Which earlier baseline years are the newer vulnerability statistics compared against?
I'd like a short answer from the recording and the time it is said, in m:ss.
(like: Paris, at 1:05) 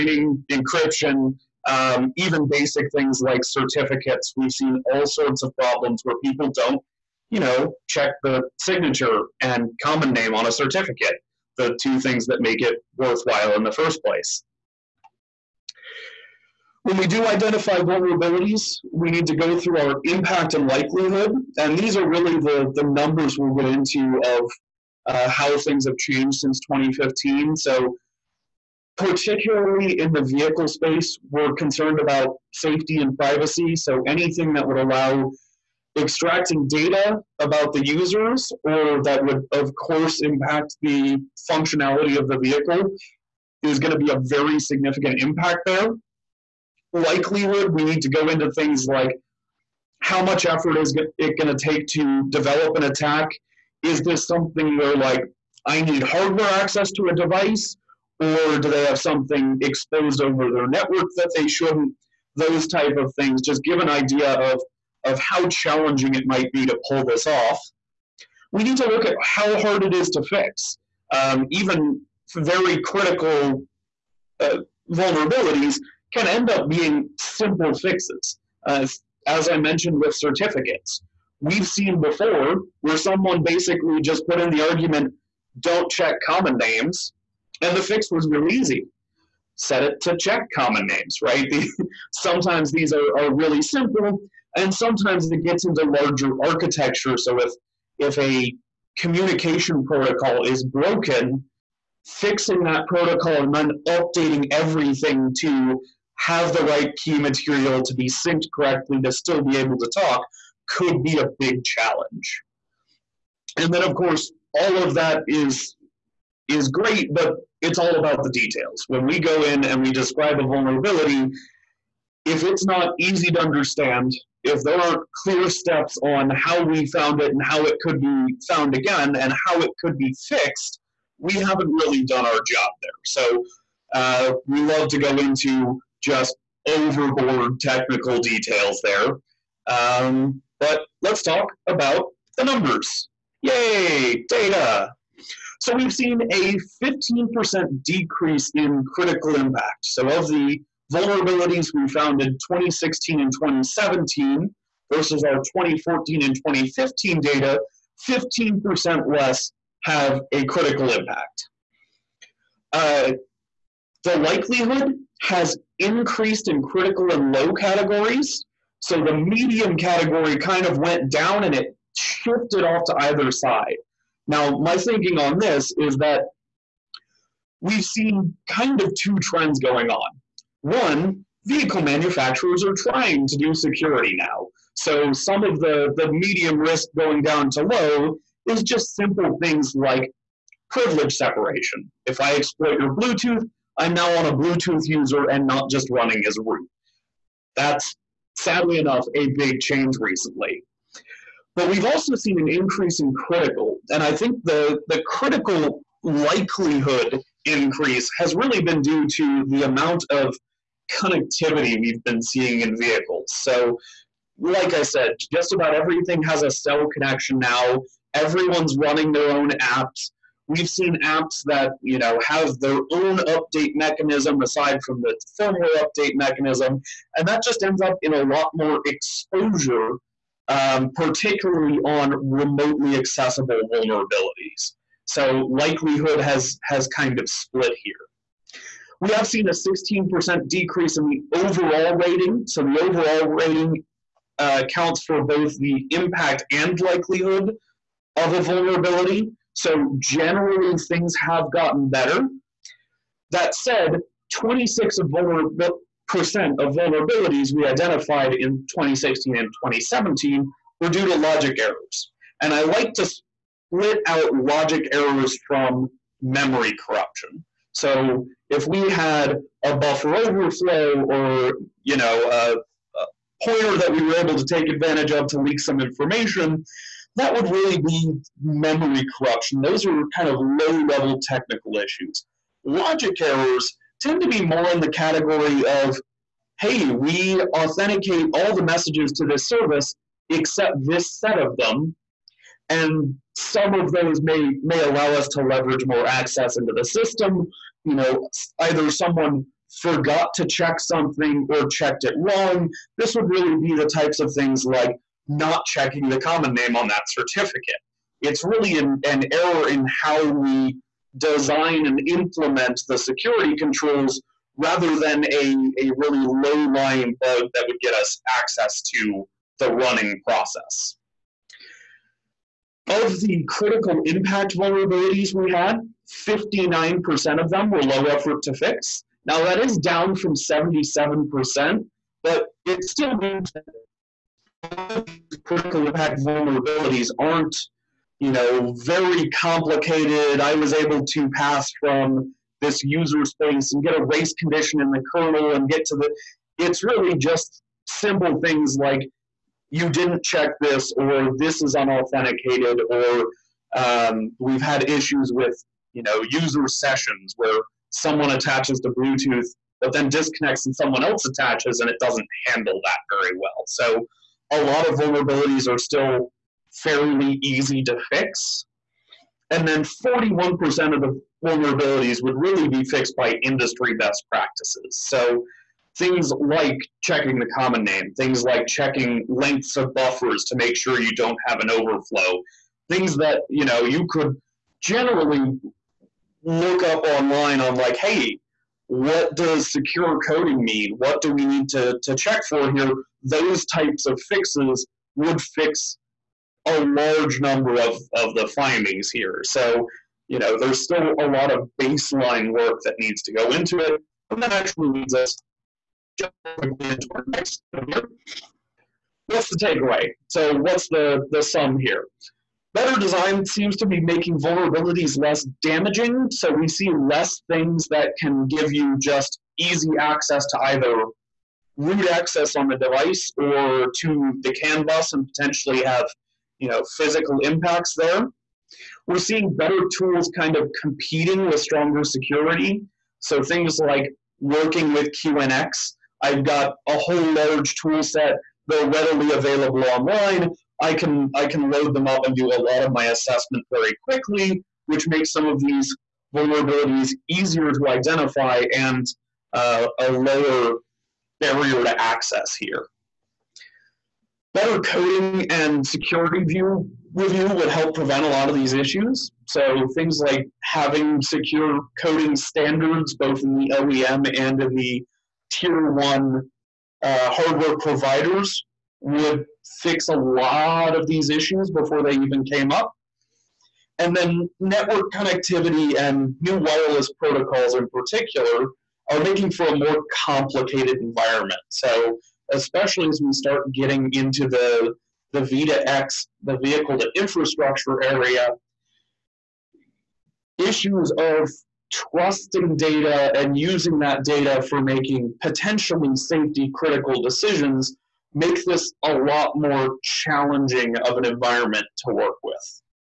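2014 and 2015, at 2:35.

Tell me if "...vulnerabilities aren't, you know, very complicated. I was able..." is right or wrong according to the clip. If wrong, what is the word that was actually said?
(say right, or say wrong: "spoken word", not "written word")
right.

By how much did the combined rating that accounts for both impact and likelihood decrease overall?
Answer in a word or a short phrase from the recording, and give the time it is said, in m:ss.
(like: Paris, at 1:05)
16%, at 3:59.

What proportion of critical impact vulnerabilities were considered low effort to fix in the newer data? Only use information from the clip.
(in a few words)
59%.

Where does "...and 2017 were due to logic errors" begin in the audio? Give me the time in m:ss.
4:19.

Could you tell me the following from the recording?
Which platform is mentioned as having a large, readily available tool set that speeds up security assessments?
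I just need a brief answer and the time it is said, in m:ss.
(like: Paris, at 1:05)
QNX, at 7:15.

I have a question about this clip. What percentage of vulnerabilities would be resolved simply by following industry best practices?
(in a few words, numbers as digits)
41%.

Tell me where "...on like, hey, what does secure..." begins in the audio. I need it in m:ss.
6:27.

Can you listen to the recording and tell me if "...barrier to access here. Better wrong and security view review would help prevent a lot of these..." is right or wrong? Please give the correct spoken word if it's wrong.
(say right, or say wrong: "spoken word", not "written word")
wrong: "coding", not "wrong".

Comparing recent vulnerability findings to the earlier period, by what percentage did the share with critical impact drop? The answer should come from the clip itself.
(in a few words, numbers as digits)
15%.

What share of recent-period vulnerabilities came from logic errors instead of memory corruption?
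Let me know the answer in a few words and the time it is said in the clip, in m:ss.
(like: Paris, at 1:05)
26%, at 4:14.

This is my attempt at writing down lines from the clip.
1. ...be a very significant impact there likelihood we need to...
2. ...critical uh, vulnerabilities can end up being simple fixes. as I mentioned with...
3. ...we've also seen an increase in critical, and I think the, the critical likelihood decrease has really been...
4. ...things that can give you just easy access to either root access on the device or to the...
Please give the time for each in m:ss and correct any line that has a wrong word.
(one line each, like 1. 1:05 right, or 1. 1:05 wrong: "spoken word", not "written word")
1. 0:43 right
2. 1:12 right
3. 3:21 wrong: "increase", not "decrease"
4. 6:57 right.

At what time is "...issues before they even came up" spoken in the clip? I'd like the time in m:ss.
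7:51.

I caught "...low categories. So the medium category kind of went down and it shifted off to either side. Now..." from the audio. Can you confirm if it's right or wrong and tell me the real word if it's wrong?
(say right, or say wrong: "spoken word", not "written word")
right.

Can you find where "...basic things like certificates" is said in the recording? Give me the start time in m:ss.
0:02.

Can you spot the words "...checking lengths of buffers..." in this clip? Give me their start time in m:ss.
6:18.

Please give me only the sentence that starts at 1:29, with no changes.
Set it to check common names, right?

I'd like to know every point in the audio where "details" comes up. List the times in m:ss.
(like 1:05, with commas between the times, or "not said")
1:58, 2:18.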